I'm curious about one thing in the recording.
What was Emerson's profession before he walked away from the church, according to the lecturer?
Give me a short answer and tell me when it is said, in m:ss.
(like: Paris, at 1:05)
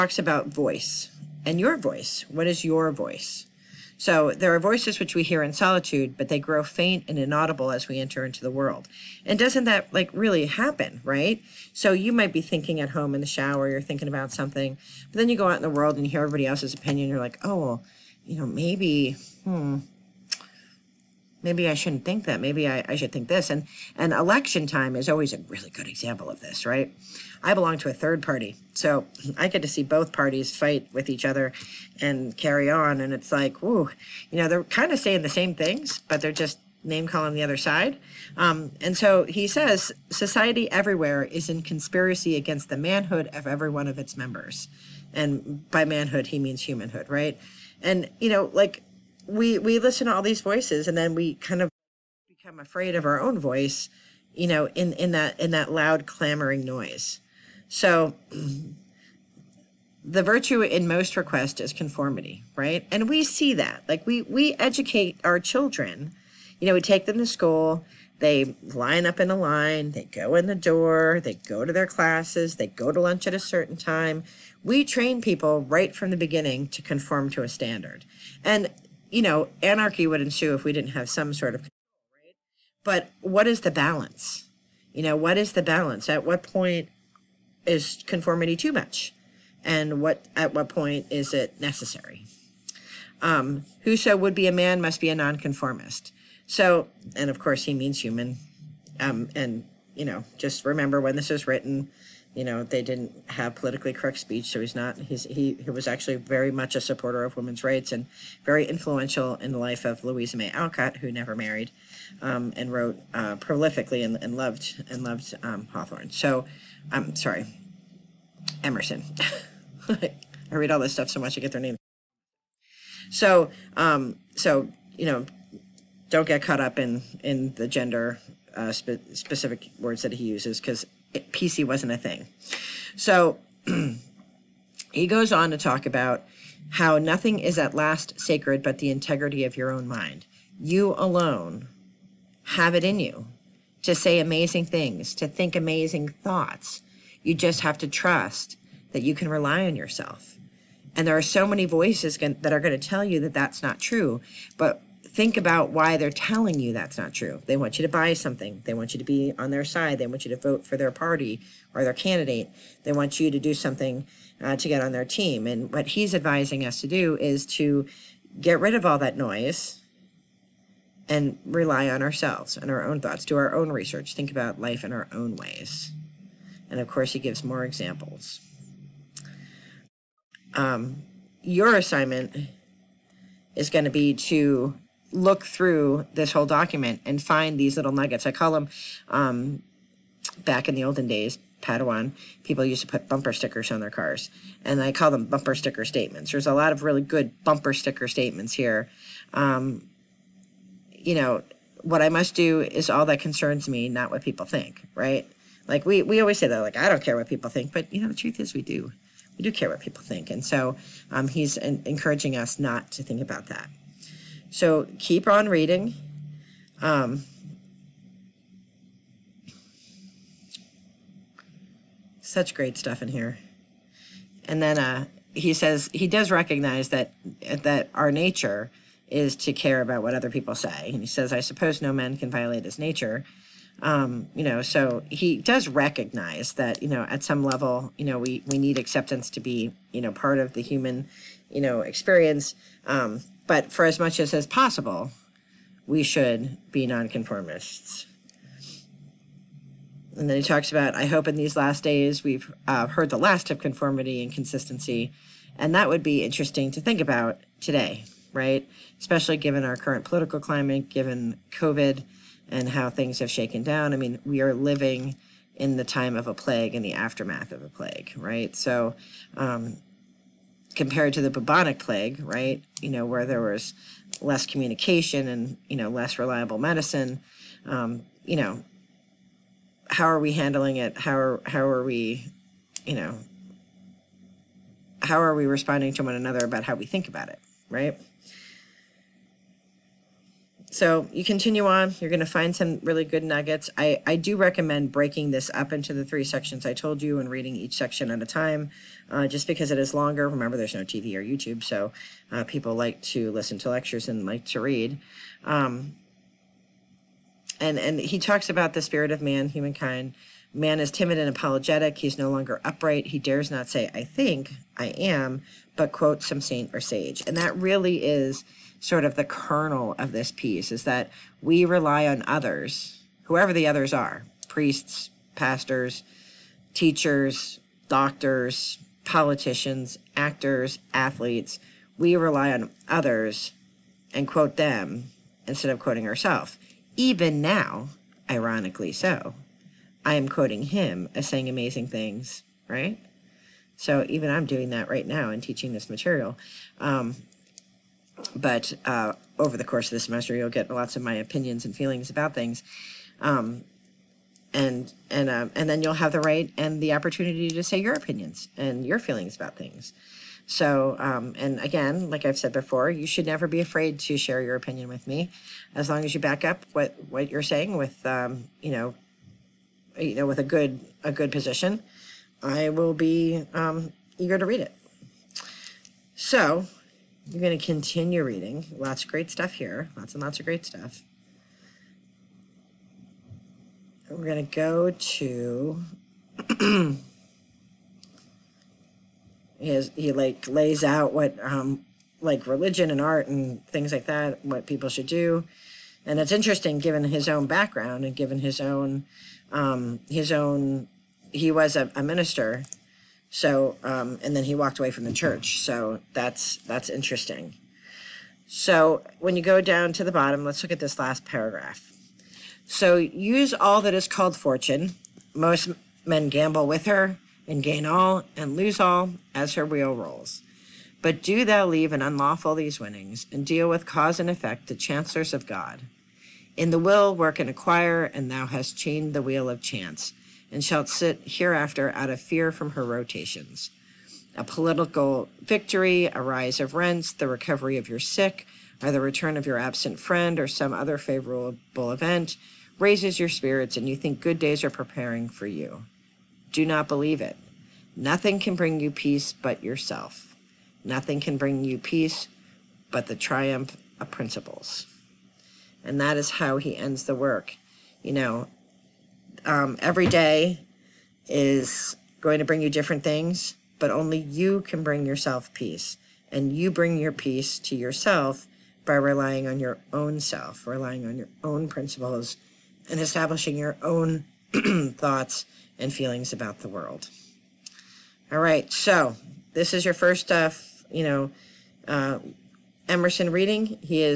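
A minister, at 6:41.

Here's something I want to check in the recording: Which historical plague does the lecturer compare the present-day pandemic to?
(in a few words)
The bubonic plague.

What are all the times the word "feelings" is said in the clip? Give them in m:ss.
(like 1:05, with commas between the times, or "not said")
5:51, 5:58, 7:55.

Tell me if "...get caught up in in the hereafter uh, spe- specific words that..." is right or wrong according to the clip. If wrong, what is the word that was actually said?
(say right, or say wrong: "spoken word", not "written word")
wrong: "gender", not "hereafter".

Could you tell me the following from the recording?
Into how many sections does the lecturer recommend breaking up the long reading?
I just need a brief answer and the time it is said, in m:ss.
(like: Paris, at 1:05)
3, at 4:56.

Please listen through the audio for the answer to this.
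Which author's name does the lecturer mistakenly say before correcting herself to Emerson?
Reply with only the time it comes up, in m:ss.
1:55.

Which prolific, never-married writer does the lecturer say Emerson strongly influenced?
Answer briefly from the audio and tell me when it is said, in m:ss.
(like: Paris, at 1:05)
Louisa May Alcott, at 1:50.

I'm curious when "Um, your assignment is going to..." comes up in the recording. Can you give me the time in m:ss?
3:00.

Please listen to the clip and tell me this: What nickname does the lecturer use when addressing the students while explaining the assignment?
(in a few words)
Padawan.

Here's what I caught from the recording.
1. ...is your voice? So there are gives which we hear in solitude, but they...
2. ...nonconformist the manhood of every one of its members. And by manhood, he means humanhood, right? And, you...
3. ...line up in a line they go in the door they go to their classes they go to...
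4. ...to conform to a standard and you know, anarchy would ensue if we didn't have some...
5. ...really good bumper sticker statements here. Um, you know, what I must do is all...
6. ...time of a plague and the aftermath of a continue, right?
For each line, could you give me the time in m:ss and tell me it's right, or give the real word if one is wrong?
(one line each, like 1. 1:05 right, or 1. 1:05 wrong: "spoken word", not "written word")
1. 0:02 wrong: "voices", not "gives"
2. 0:42 wrong: "against", not "nonconformist"
3. 1:08 right
4. 1:16 right
5. 3:16 right
6. 4:25 wrong: "plague", not "continue".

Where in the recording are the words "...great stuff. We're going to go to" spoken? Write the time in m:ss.
6:20.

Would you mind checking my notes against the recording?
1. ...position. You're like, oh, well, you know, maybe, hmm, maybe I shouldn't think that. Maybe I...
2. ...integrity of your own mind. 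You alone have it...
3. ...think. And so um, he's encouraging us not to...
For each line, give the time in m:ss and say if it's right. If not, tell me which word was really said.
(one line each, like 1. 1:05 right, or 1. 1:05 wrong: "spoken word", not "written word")
1. 0:16 wrong: "opinion", not "position"
2. 2:18 right
3. 3:30 right.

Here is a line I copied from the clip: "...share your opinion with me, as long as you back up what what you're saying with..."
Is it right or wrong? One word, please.
right.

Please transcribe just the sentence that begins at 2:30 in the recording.
And there are so many voices that are going to tell you that that's not true.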